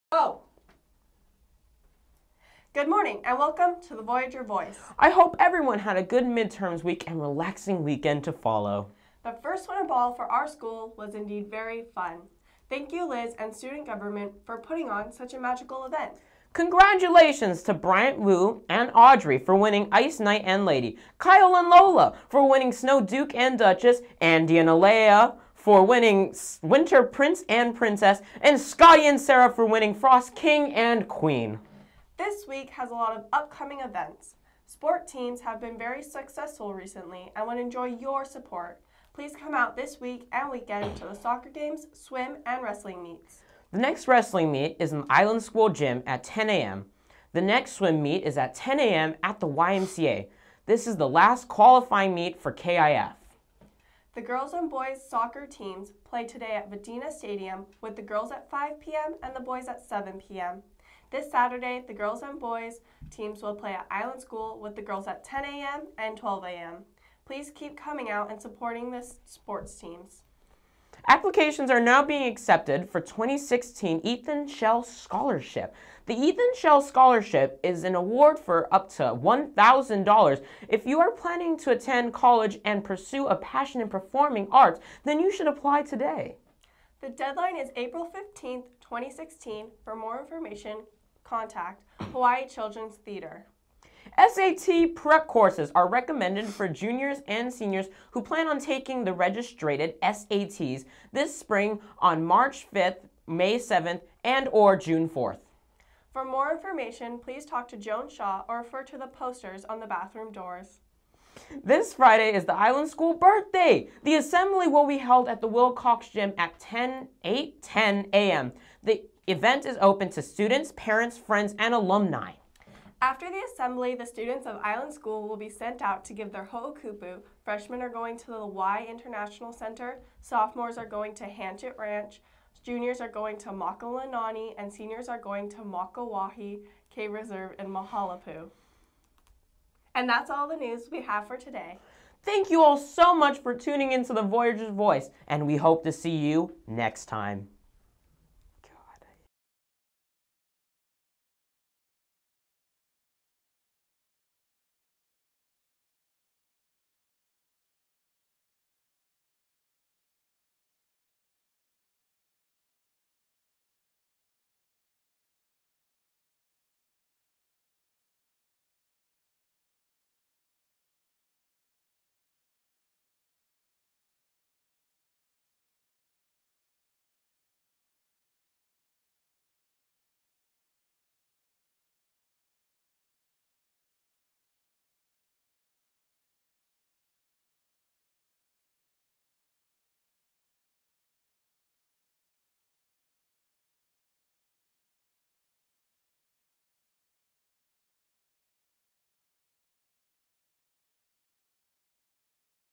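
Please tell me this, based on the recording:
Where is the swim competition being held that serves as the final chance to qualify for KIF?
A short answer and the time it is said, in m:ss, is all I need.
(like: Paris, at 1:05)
YMCA, at 0:49.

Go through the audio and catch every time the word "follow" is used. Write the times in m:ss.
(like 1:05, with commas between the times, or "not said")
0:08.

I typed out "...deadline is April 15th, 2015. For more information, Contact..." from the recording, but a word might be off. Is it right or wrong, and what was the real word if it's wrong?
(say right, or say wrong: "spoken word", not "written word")
wrong: "2016", not "2015".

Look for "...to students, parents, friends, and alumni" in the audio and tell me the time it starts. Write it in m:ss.
2:00.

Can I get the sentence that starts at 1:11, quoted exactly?
Applications are now being accepted for 2016 Ethan Shell Scholarship.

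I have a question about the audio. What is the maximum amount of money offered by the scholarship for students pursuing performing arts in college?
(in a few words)
$1,000.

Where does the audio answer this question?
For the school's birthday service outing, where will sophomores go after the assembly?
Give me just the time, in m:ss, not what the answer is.
2:11.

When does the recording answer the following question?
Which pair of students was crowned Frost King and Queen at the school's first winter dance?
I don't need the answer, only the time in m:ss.
0:28.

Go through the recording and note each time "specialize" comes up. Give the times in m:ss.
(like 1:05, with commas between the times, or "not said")
not said.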